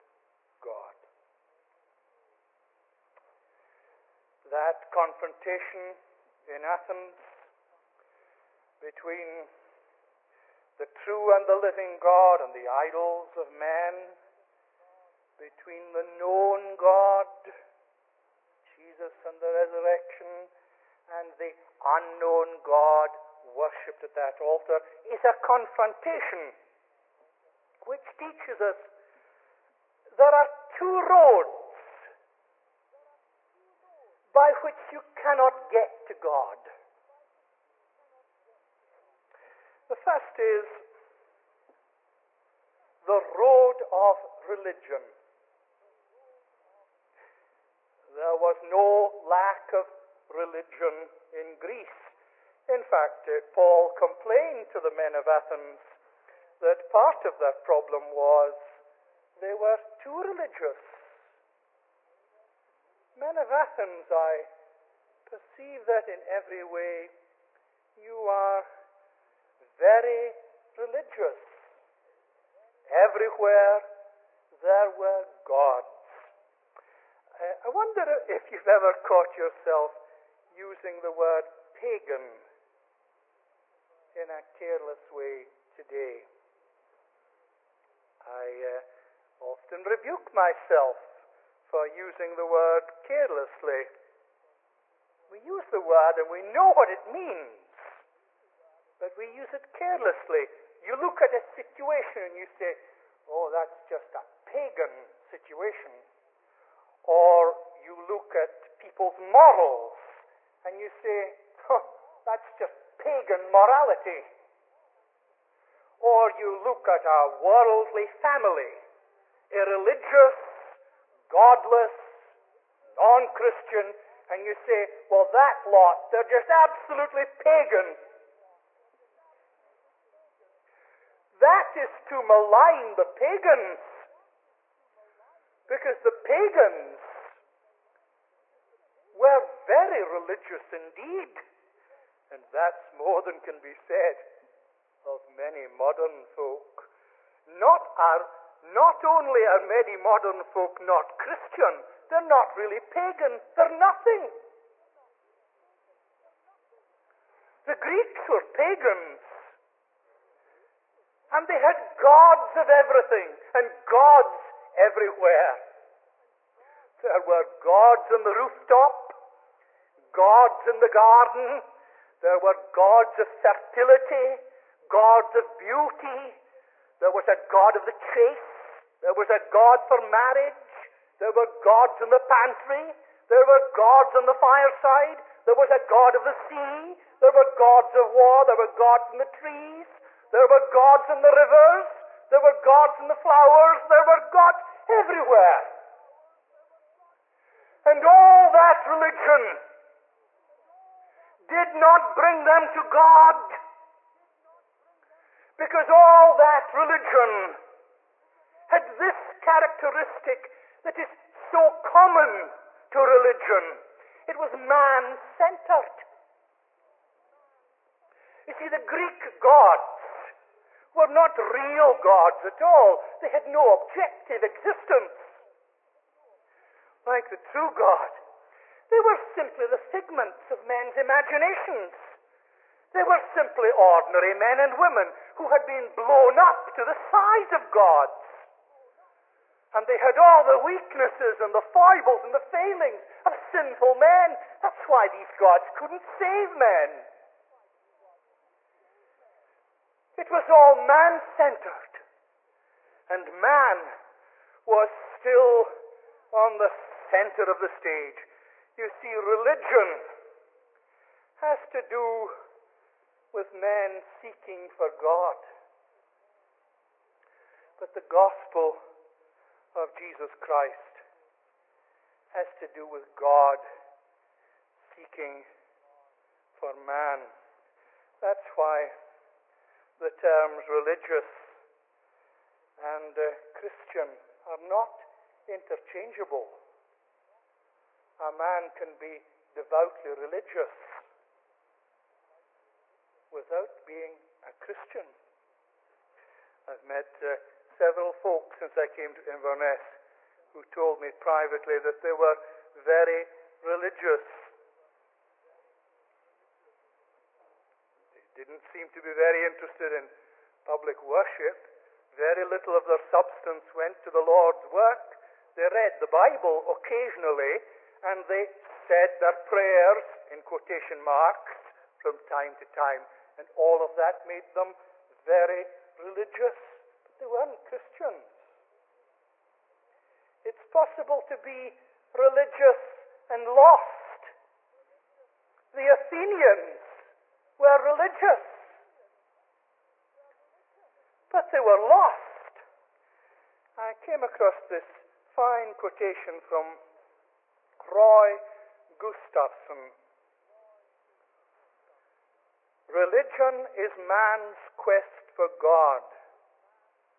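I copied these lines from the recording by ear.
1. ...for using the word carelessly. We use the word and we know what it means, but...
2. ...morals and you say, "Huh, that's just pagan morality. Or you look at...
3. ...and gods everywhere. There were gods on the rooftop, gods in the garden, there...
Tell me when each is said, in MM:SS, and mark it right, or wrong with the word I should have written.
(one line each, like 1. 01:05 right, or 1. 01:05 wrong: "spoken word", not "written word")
1. 01:31 right
2. 01:49 right
3. 02:43 right.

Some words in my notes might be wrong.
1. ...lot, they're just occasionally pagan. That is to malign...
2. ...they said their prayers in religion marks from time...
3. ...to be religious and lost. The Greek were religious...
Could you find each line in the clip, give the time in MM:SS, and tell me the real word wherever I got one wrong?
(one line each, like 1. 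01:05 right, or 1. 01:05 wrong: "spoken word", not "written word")
1. 02:05 wrong: "absolutely", not "occasionally"
2. 05:18 wrong: "quotation", not "religion"
3. 05:31 wrong: "Athenians", not "Greek".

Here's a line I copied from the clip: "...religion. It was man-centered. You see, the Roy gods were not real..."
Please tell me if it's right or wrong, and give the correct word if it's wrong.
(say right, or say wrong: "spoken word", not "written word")
wrong: "Greek", not "Roy".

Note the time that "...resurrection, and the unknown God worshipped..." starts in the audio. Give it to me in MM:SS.
00:19.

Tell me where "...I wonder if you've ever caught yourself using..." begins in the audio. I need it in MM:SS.
01:17.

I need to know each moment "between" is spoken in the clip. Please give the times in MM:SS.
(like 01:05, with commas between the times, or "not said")
00:08, 00:15.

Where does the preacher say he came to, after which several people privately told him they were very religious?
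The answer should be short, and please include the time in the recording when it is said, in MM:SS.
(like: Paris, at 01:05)
Inverness, at 04:59.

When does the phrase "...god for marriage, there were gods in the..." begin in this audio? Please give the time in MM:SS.
02:59.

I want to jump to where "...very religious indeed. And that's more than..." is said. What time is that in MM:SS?
02:19.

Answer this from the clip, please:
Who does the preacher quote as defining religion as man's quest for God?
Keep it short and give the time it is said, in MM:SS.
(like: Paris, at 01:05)
Roy Gustafson, at 05:47.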